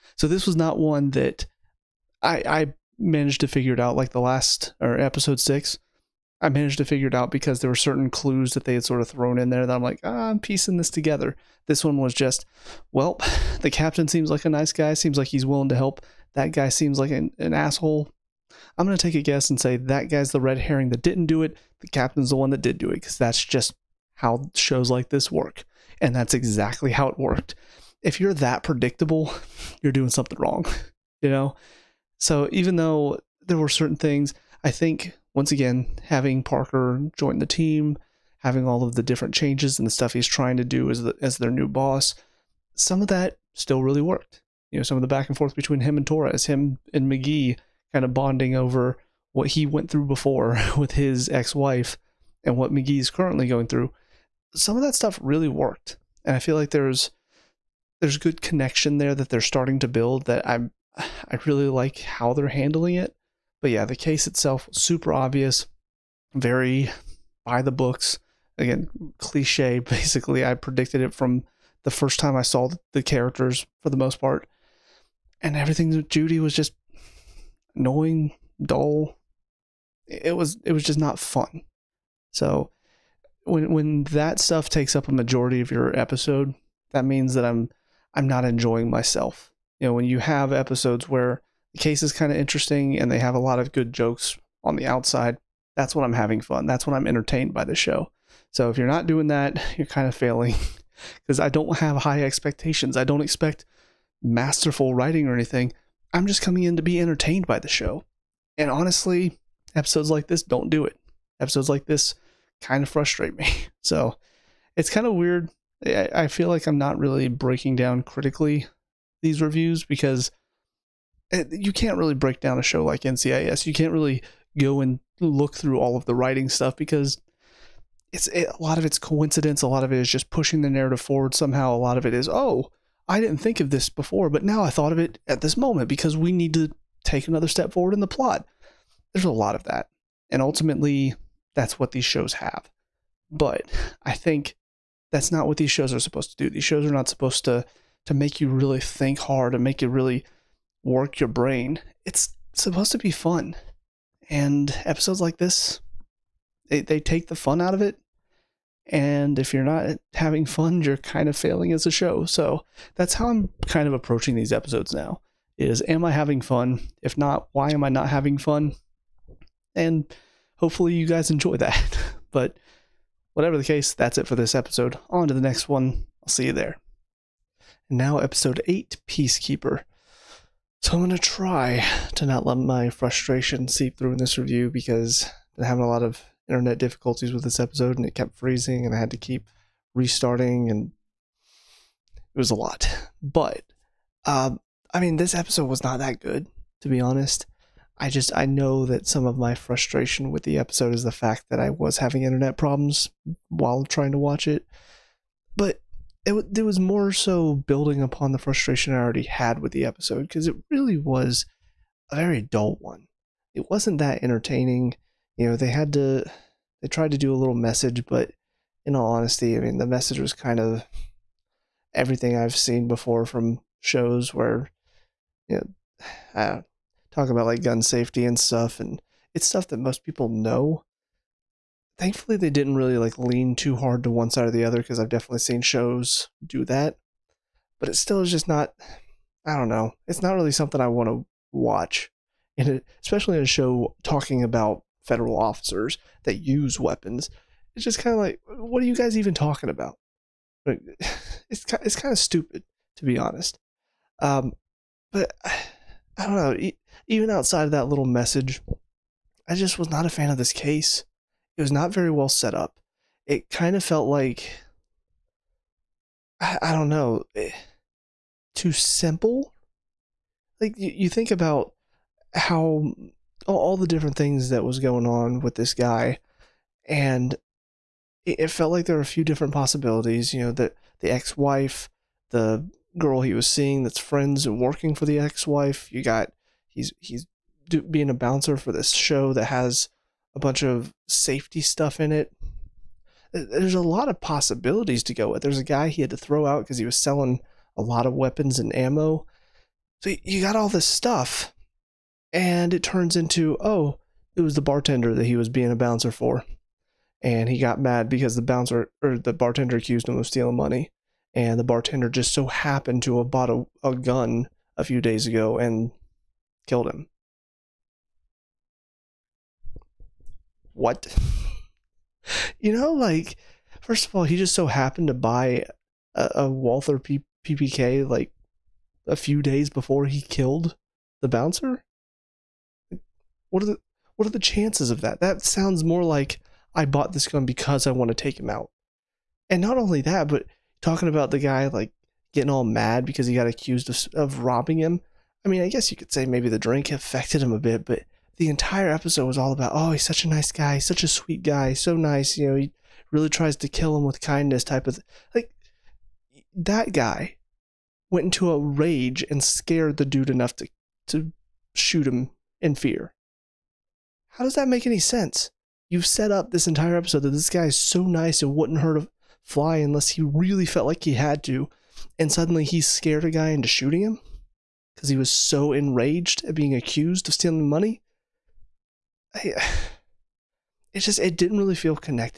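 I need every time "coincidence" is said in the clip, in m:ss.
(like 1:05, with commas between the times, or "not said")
2:08.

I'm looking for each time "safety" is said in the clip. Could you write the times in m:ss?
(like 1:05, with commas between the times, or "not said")
3:47, 4:51.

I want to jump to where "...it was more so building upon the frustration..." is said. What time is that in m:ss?
3:26.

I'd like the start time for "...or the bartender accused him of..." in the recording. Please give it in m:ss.
5:09.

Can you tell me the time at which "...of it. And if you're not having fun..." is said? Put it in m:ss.
2:37.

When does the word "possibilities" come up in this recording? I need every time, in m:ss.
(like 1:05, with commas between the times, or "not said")
4:39, 4:54.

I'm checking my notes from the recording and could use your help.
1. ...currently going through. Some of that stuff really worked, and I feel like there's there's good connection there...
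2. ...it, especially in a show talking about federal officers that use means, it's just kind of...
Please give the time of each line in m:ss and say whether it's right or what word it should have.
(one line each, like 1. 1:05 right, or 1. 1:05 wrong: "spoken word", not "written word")
1. 0:53 right
2. 4:02 wrong: "weapons", not "means".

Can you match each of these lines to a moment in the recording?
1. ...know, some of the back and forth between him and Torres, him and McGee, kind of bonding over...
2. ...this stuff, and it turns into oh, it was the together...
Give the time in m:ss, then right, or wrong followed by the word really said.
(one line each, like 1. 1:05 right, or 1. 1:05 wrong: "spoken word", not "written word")
1. 0:44 right
2. 5:00 wrong: "bartender", not "together".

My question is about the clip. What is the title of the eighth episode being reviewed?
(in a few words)
Peacekeeper.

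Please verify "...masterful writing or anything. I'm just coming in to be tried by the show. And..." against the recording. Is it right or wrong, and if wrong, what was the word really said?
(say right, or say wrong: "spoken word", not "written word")
wrong: "entertained", not "tried".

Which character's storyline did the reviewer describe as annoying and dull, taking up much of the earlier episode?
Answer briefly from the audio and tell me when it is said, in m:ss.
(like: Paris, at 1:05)
Judy, at 1:16.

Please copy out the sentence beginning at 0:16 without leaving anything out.
That guy seems like an, an asshole.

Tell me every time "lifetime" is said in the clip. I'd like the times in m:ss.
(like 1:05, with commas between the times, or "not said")
not said.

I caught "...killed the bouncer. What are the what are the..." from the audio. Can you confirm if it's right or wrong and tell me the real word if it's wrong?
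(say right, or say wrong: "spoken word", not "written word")
right.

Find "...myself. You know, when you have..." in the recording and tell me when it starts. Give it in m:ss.
1:28.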